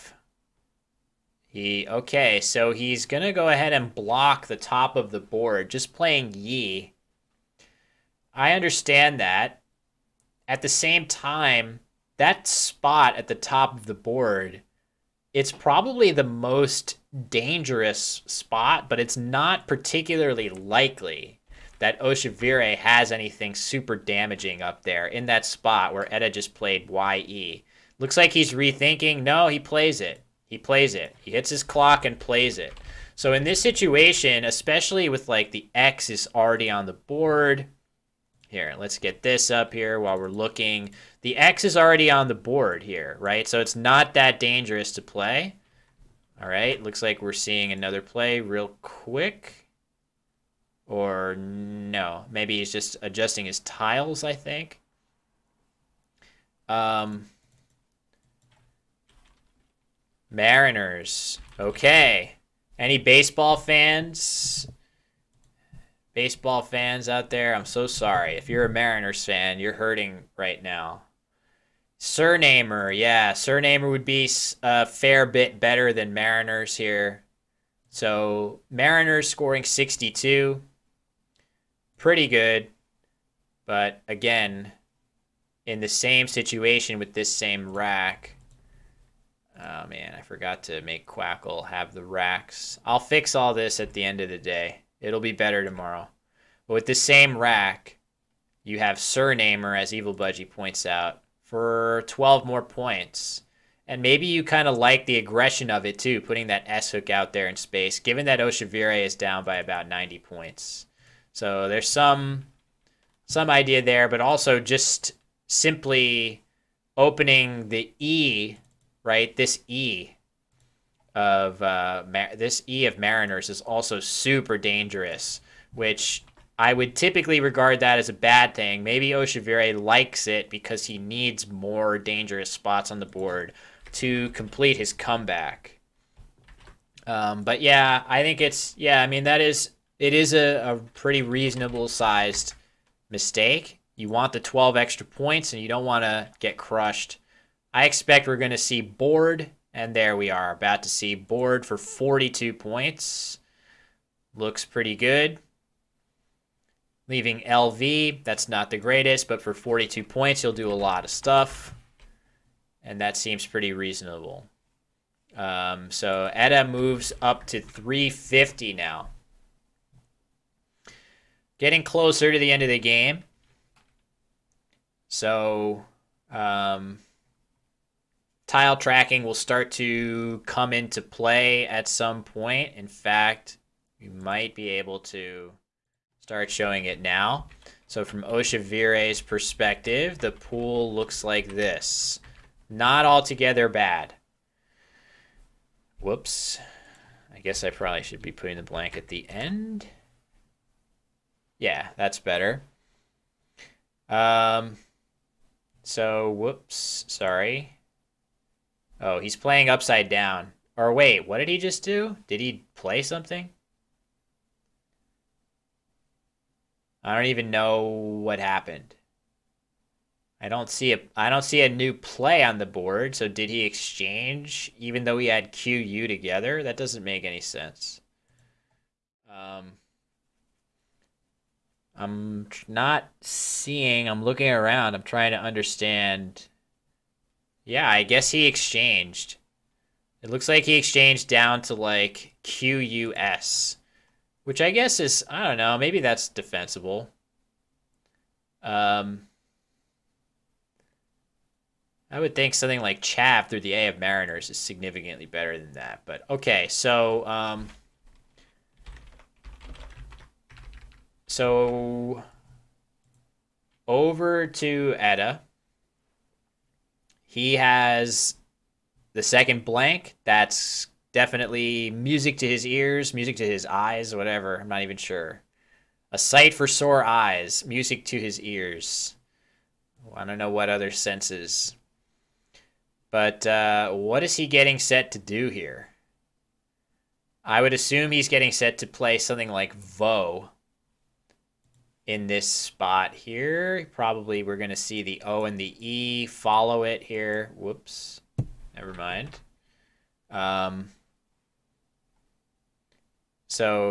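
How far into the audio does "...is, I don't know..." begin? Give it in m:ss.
4:04.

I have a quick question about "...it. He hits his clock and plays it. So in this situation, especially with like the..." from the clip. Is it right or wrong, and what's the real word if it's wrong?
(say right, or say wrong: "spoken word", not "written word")
right.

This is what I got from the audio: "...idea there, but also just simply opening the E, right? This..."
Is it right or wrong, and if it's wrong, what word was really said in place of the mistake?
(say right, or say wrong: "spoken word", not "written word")
right.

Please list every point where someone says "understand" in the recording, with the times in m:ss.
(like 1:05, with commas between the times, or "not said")
0:08, 3:55.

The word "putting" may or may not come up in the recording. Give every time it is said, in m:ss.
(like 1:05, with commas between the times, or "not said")
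1:46, 3:18.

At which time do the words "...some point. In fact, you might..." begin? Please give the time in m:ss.
3:01.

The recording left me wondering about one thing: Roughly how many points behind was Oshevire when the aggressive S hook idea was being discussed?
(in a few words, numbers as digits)
90.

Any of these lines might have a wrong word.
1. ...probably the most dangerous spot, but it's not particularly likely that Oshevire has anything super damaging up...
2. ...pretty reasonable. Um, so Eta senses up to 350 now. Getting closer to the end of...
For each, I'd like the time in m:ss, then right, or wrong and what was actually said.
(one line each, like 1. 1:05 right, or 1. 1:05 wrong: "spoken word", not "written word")
1. 0:15 right
2. 2:43 wrong: "moves", not "senses".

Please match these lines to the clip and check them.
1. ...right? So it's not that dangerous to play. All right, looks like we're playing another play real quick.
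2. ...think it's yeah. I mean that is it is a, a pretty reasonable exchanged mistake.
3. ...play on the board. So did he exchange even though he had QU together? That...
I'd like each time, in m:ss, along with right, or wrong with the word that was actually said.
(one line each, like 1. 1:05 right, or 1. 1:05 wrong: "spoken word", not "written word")
1. 0:43 wrong: "seeing", not "playing"
2. 2:18 wrong: "sized", not "exchanged"
3. 3:41 right.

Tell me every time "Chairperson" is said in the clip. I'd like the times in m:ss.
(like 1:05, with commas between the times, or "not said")
not said.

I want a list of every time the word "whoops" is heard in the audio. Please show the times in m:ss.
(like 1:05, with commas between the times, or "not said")
3:15, 3:26, 4:57.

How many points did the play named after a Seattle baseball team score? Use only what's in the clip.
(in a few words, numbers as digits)
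62.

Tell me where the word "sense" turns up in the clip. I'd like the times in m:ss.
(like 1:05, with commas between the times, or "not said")
3:47, 4:40.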